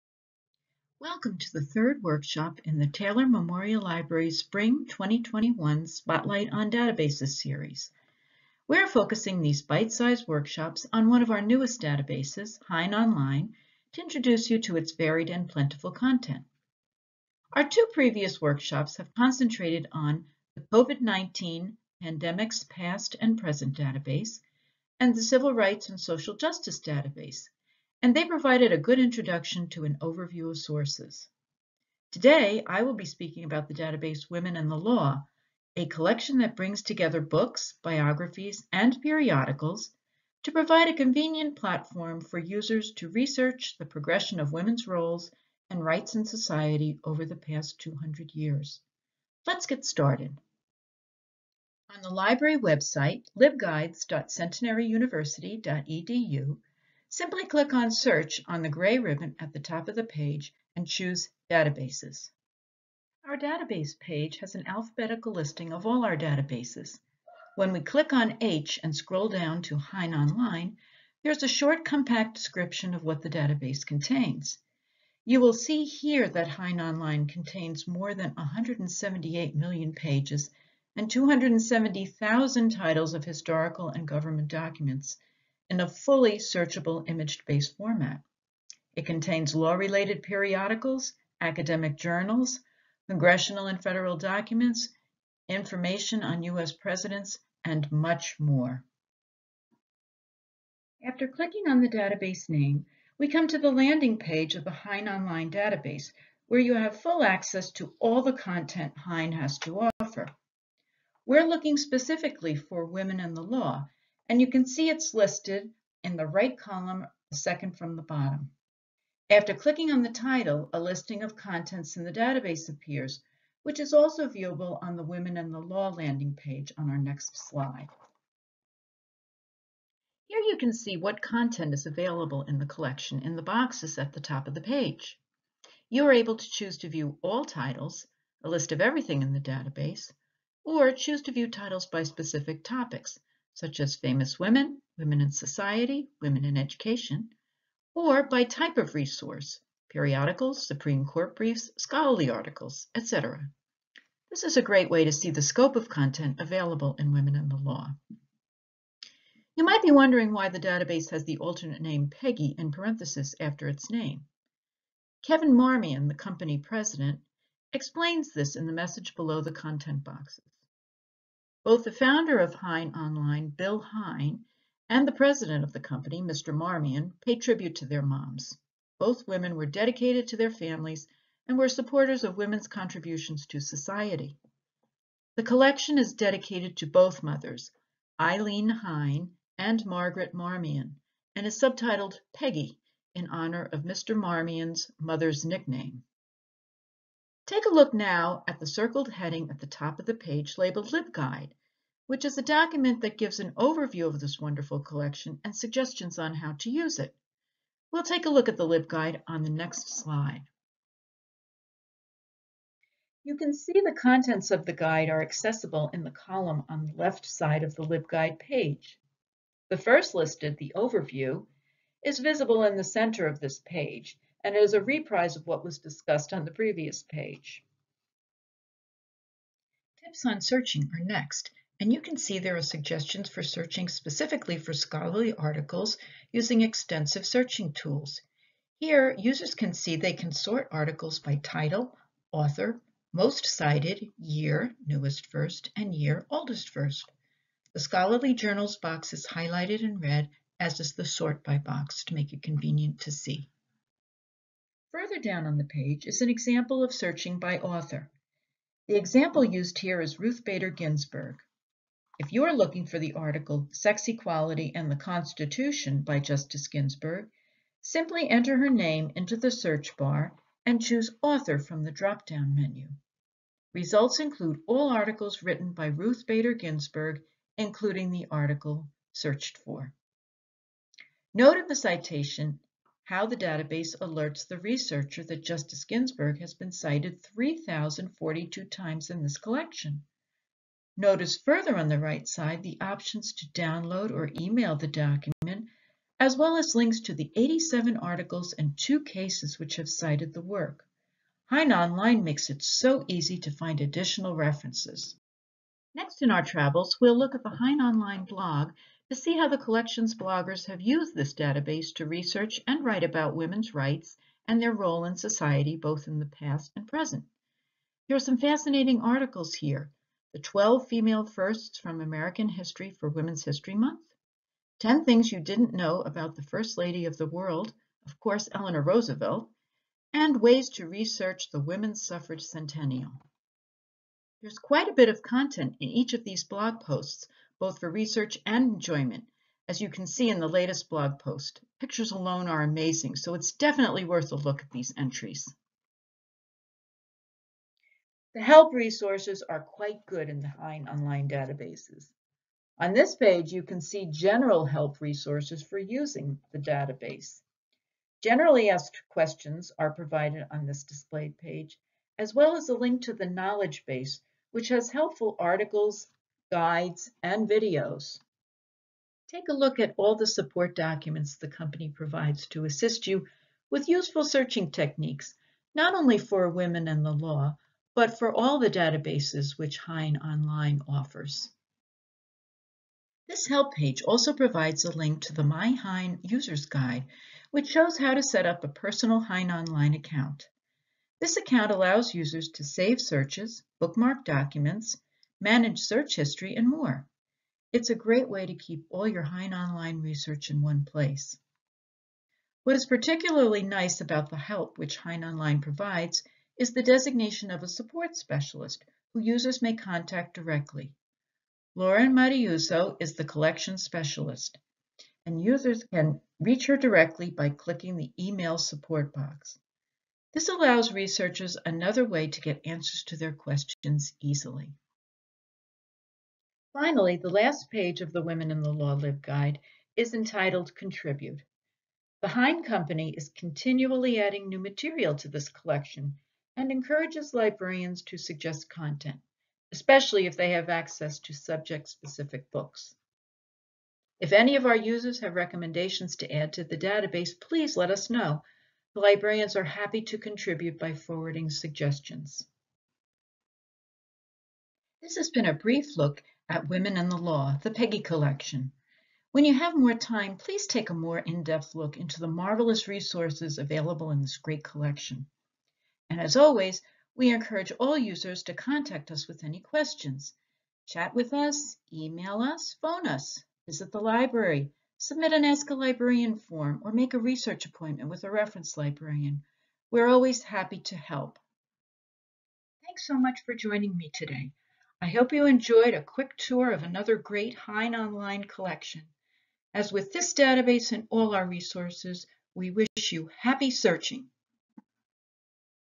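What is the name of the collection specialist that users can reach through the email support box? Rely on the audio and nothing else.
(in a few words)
Lauren Mariuso.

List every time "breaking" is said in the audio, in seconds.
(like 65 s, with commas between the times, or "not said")
not said.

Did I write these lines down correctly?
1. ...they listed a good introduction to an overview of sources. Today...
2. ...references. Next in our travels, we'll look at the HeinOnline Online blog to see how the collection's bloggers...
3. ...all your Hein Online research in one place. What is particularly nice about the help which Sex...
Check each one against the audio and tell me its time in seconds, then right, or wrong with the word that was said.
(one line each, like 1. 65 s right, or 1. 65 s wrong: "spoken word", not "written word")
1. 28 s wrong: "provided", not "listed"
2. 304 s right
3. 398 s wrong: "Hein", not "Sex".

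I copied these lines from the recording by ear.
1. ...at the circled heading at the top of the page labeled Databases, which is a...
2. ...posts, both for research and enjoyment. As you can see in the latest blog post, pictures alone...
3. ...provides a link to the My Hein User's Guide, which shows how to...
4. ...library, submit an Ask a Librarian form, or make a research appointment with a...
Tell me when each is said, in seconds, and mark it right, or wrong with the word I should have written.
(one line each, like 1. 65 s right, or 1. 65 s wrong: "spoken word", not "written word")
1. 198 s wrong: "LibGuide", not "Databases"
2. 336 s right
3. 384 s right
4. 474 s right.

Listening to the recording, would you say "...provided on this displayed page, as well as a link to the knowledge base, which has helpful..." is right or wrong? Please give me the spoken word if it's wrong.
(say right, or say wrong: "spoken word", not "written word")
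right.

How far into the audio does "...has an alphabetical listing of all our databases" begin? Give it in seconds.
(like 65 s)
64 s.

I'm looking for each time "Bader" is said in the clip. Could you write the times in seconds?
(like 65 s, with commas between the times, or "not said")
260 s, 276 s.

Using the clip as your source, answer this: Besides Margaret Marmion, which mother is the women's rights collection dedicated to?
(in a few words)
Eileen Hein.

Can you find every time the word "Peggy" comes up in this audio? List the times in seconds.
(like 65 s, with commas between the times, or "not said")
162 s, 192 s, 457 s.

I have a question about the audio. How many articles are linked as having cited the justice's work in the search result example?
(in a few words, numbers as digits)
87.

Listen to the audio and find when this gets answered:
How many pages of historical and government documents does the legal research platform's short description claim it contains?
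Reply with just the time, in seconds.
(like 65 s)
78 s.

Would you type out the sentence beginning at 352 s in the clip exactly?
On this page, you can see general help resources for using the database.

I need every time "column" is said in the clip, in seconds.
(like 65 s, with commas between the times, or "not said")
116 s, 216 s.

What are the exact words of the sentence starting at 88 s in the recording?
It contains law-related periodicals, academic journals, congressional and federal documents, information on U.S.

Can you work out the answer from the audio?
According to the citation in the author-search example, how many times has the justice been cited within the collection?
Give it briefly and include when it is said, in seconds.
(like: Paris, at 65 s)
3,042, at 287 s.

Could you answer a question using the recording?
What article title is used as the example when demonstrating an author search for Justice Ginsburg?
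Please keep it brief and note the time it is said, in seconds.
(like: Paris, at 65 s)
Sex Equality and the Constitution, at 263 s.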